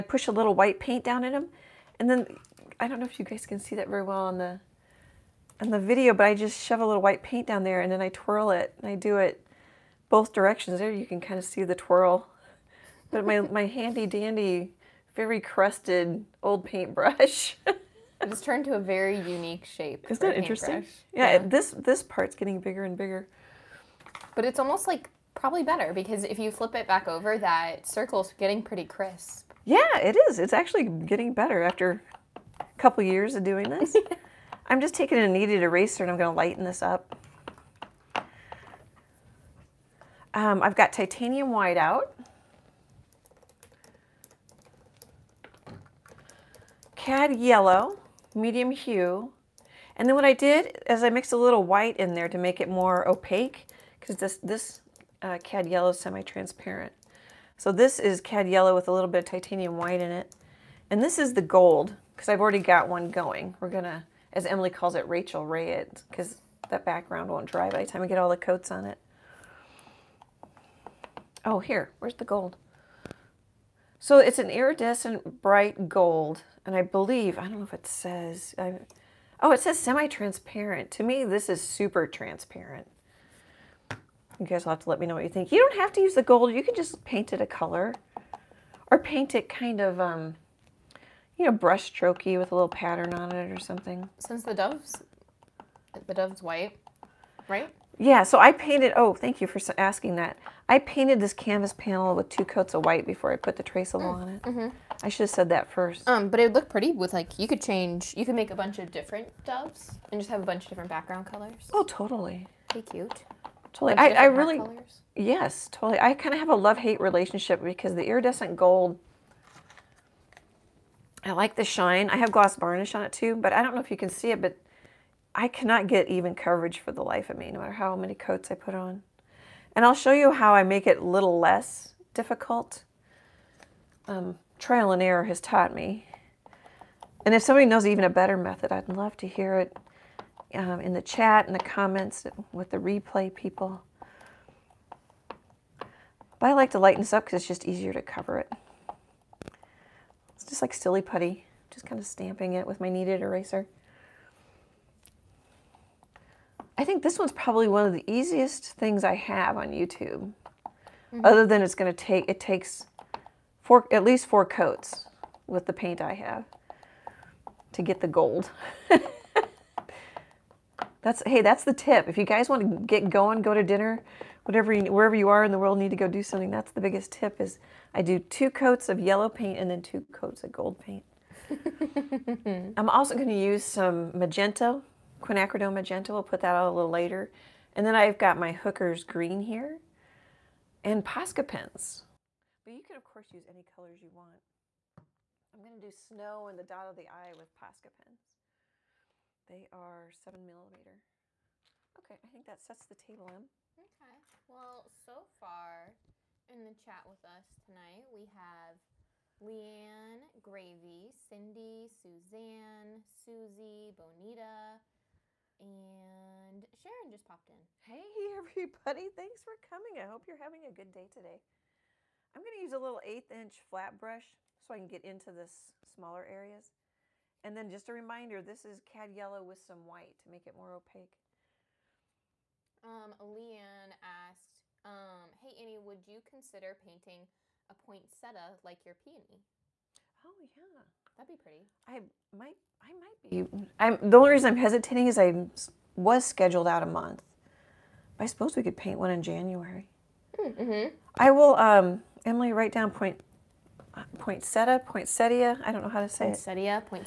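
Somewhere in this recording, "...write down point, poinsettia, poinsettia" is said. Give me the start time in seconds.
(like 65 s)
252 s.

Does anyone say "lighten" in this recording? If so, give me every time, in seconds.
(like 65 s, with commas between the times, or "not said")
36 s, 146 s.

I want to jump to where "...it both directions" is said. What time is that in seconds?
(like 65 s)
9 s.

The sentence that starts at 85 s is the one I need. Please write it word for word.
You don't have to use the gold.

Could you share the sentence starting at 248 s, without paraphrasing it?
I suppose we could paint one in January.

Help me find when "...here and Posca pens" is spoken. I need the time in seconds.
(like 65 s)
189 s.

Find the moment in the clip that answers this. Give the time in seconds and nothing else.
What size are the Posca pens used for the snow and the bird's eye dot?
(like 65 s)
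200 s.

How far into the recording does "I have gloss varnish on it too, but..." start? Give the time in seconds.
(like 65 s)
122 s.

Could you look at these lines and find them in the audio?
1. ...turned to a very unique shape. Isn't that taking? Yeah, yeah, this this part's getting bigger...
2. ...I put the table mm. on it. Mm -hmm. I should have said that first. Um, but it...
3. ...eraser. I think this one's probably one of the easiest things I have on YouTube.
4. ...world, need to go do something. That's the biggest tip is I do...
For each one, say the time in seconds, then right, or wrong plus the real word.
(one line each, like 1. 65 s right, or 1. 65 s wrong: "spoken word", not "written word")
1. 18 s wrong: "interesting", not "taking"
2. 103 s wrong: "traceable", not "table"
3. 153 s right
4. 175 s right.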